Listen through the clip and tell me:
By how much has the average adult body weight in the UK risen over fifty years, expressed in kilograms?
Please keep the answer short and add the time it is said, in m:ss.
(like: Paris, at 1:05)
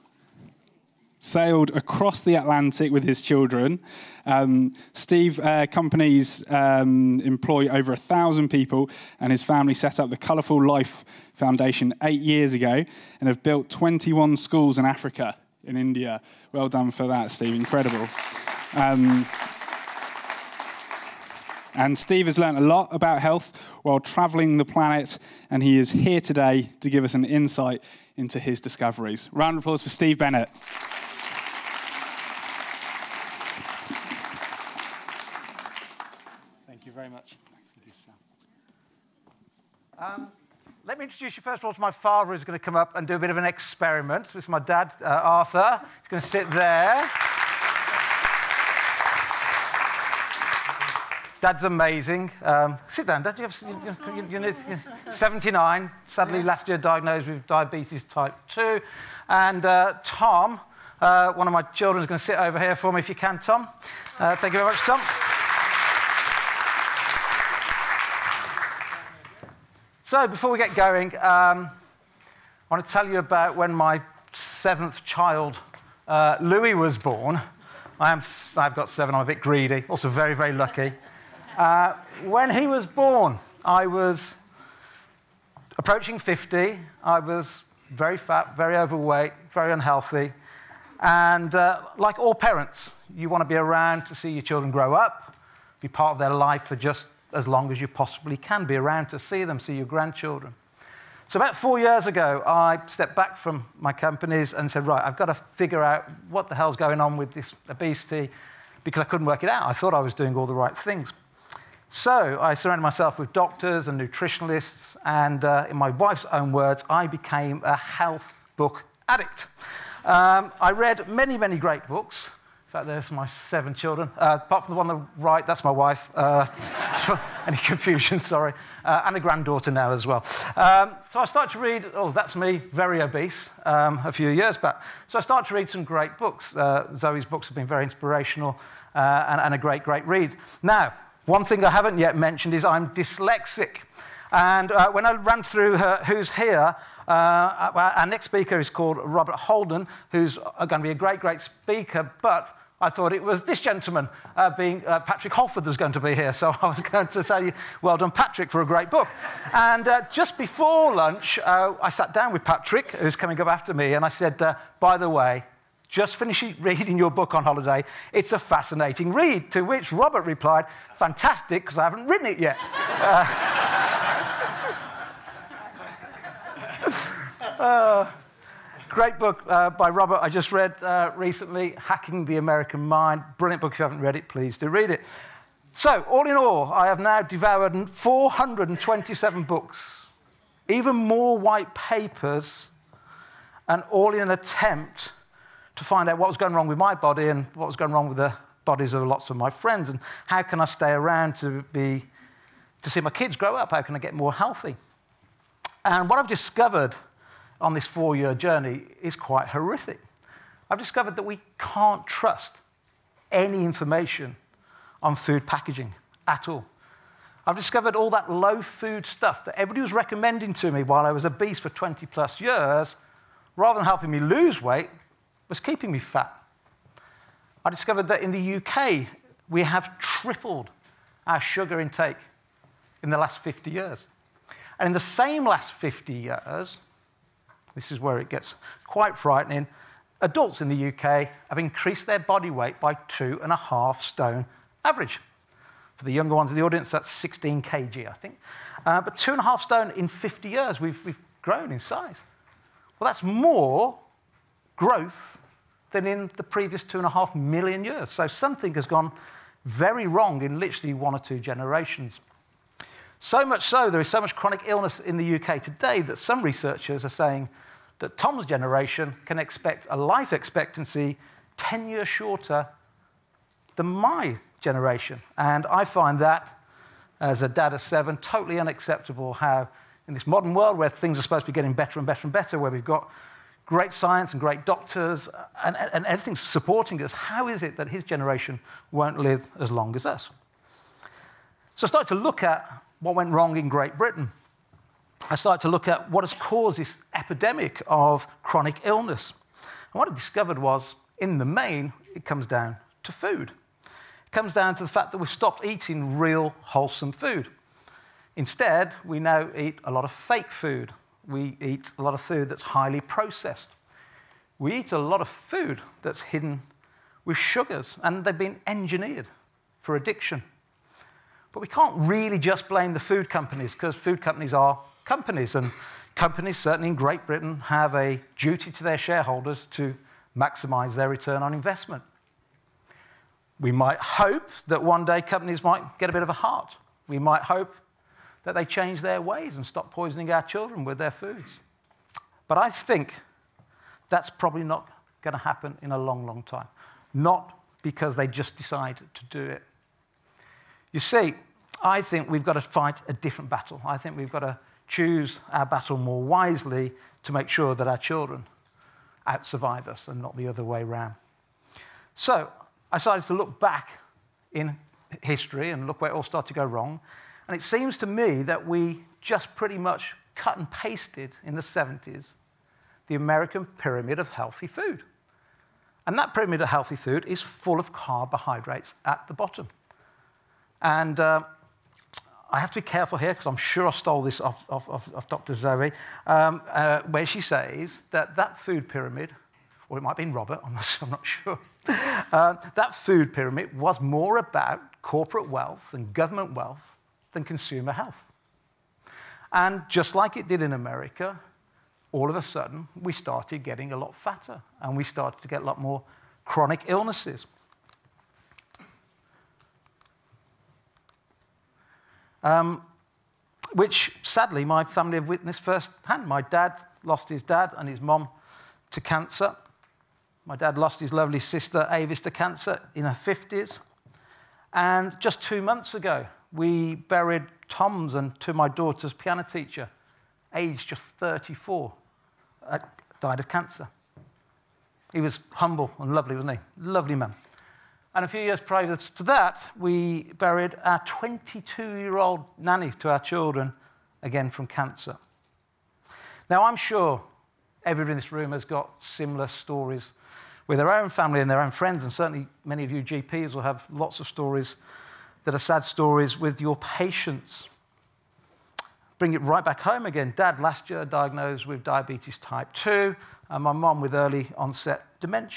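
16 kg, at 4:07.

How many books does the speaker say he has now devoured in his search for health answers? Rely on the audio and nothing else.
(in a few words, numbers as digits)
427.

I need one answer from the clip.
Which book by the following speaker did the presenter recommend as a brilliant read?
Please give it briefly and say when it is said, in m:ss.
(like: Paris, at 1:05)
Hacking the American Mind, at 3:01.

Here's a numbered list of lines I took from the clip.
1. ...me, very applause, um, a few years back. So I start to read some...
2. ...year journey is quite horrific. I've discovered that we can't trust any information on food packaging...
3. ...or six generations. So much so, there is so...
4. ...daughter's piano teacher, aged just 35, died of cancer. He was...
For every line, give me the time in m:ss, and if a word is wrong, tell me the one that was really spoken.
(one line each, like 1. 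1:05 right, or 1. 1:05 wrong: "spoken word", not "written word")
1. 2:12 wrong: "obese", not "applause"
2. 3:28 right
3. 4:21 wrong: "two", not "six"
4. 7:08 wrong: "34", not "35".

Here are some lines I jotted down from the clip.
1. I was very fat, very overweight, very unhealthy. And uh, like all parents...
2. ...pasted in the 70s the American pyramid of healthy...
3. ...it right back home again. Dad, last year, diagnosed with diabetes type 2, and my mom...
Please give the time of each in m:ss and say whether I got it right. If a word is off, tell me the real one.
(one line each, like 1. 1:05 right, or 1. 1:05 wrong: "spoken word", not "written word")
1. 1:27 right
2. 6:10 right
3. 7:39 right.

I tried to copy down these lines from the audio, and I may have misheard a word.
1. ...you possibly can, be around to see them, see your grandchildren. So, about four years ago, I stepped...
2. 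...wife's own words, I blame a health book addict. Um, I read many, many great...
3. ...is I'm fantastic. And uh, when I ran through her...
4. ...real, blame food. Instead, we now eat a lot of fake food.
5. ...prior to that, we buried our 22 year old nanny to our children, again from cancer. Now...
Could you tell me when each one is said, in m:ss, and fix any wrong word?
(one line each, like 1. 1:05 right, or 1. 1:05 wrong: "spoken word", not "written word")
1. 1:37 right
2. 1:55 wrong: "became", not "blame"
3. 2:22 wrong: "dyslexic", not "fantastic"
4. 5:06 wrong: "wholesome", not "blame"
5. 7:18 right.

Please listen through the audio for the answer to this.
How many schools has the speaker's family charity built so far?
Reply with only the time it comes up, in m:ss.
0:13.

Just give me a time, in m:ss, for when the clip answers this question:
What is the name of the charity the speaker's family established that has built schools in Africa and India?
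0:10.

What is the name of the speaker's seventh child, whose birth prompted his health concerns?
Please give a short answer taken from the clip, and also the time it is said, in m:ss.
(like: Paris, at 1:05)
Louis, at 1:16.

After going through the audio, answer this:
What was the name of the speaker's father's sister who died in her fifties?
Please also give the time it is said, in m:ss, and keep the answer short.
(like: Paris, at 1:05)
Avis, at 7:01.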